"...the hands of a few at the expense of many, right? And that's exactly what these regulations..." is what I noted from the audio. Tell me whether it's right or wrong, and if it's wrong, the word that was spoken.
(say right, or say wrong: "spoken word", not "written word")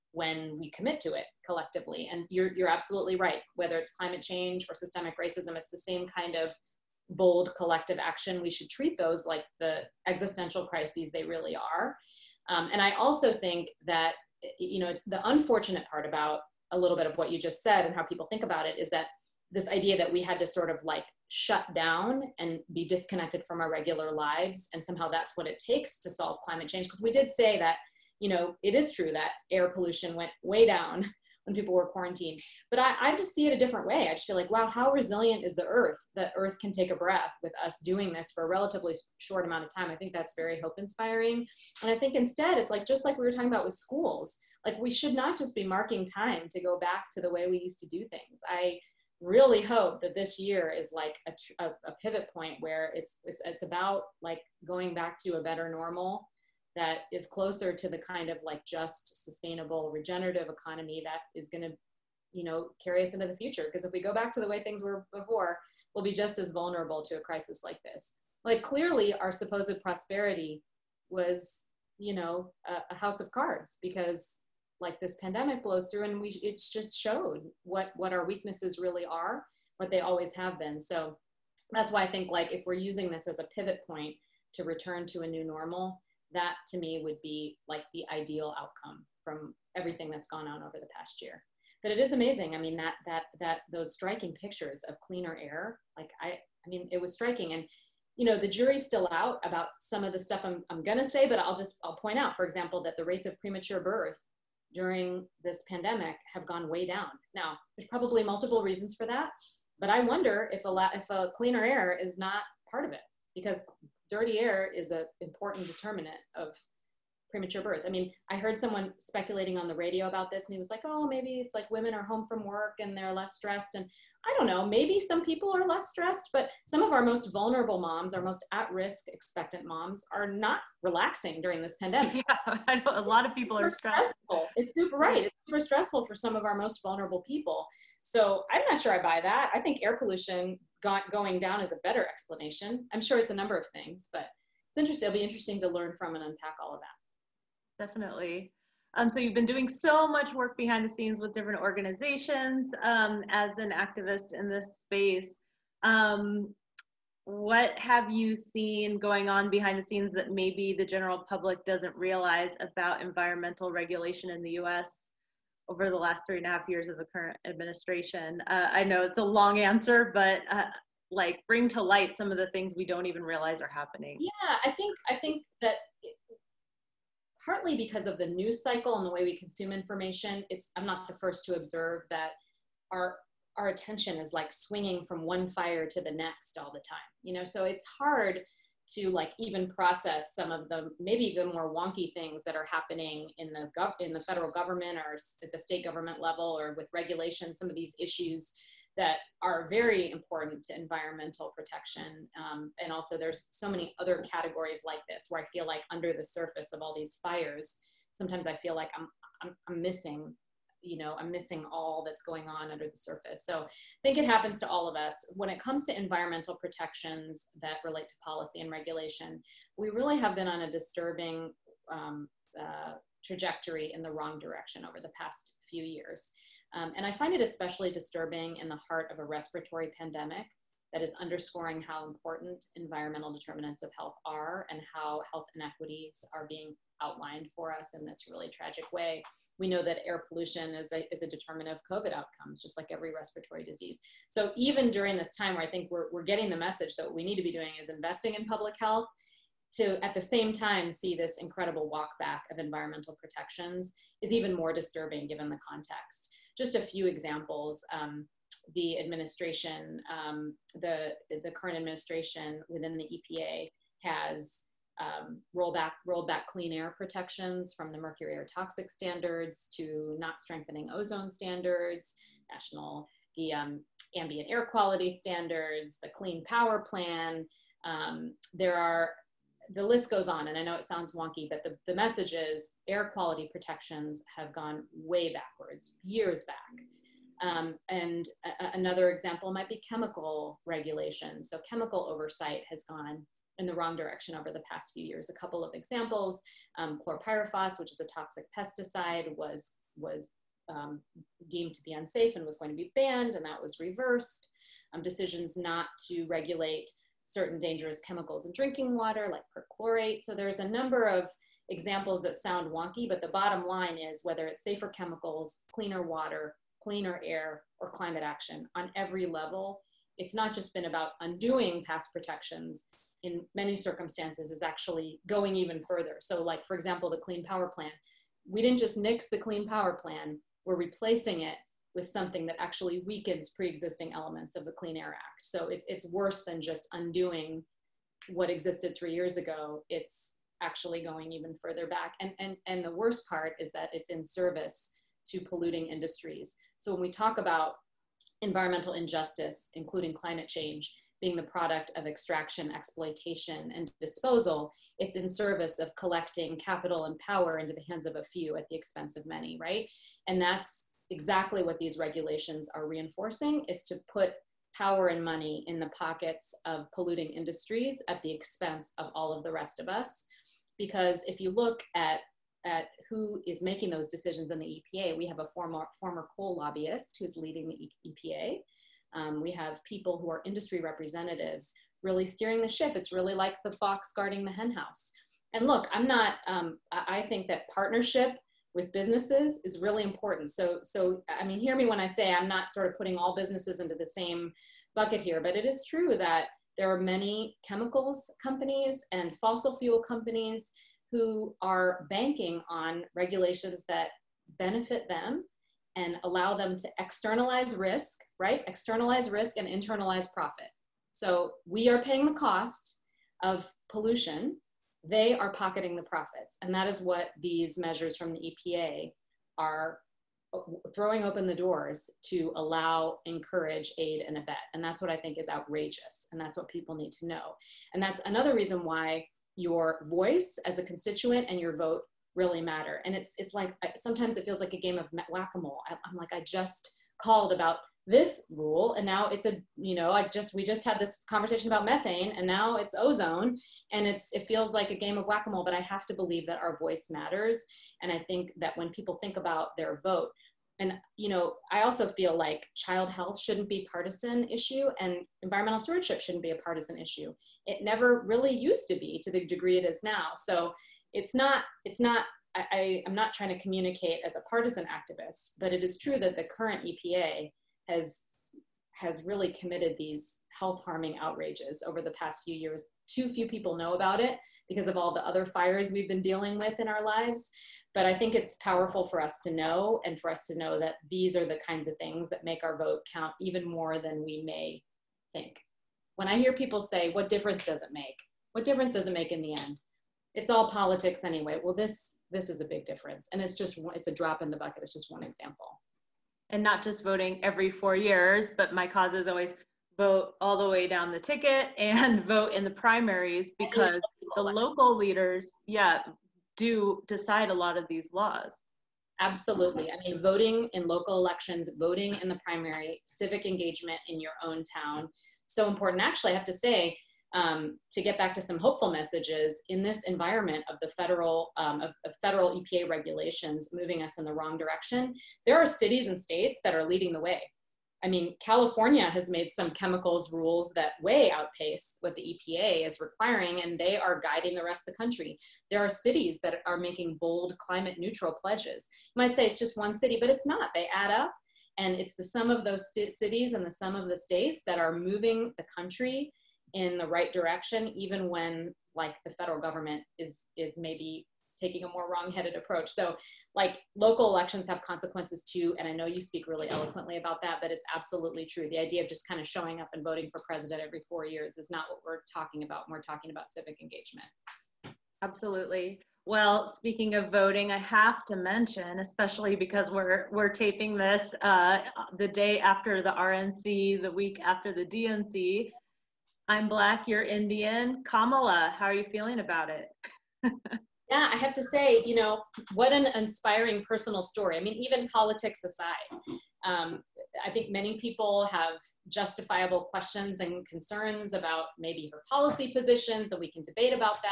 right.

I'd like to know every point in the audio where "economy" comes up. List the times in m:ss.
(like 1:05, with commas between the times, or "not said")
1:00.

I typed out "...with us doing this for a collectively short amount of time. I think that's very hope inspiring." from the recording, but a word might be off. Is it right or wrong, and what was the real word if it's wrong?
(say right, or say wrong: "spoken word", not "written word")
wrong: "relatively", not "collectively".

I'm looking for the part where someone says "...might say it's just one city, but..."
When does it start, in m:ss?
8:59.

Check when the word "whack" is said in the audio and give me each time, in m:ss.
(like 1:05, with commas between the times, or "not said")
7:15, 7:25.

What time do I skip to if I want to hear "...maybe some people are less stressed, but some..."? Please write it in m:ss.
2:04.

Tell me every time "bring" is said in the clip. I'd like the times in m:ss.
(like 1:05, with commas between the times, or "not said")
2:51.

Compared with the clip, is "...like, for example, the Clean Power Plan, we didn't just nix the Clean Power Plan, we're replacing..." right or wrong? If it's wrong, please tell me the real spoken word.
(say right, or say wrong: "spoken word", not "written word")
right.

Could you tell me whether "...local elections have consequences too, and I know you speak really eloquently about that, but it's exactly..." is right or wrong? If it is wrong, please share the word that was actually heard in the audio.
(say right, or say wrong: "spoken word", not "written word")
wrong: "absolutely", not "exactly".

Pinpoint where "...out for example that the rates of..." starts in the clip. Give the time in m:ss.
1:42.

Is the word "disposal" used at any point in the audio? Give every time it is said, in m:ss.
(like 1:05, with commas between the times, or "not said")
5:54.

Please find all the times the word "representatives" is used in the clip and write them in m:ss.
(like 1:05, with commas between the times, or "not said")
6:20.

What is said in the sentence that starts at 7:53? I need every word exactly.
Too few people know about it because of all the other fires we've been dealing with in our lives.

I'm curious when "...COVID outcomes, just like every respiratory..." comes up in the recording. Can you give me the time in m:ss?
4:01.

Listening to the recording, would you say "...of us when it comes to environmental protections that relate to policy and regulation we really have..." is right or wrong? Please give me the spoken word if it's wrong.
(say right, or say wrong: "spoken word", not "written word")
right.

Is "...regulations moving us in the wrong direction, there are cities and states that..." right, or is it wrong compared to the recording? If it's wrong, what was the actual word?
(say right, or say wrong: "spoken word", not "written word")
right.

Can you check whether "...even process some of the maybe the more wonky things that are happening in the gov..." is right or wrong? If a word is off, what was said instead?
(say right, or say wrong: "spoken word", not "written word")
right.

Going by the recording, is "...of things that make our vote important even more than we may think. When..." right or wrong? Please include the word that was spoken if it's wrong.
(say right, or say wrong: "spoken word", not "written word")
wrong: "count", not "important".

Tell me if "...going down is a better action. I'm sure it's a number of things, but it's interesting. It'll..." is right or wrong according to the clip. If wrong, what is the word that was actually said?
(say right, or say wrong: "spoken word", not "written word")
wrong: "explanation", not "action".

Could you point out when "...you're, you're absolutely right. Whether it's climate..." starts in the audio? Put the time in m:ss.
0:02.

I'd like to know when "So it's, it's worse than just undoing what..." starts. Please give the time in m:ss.
5:35.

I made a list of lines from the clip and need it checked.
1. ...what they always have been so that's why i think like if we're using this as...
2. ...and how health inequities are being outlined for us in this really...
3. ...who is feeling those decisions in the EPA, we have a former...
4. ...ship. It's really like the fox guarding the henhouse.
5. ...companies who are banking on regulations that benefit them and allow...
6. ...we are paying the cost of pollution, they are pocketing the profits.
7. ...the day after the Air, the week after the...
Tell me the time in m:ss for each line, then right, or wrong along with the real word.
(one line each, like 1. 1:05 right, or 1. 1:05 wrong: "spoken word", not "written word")
1. 1:19 right
2. 3:54 right
3. 6:13 wrong: "making", not "feeling"
4. 6:22 right
5. 6:40 right
6. 6:51 right
7. 9:32 wrong: "RNC", not "Air".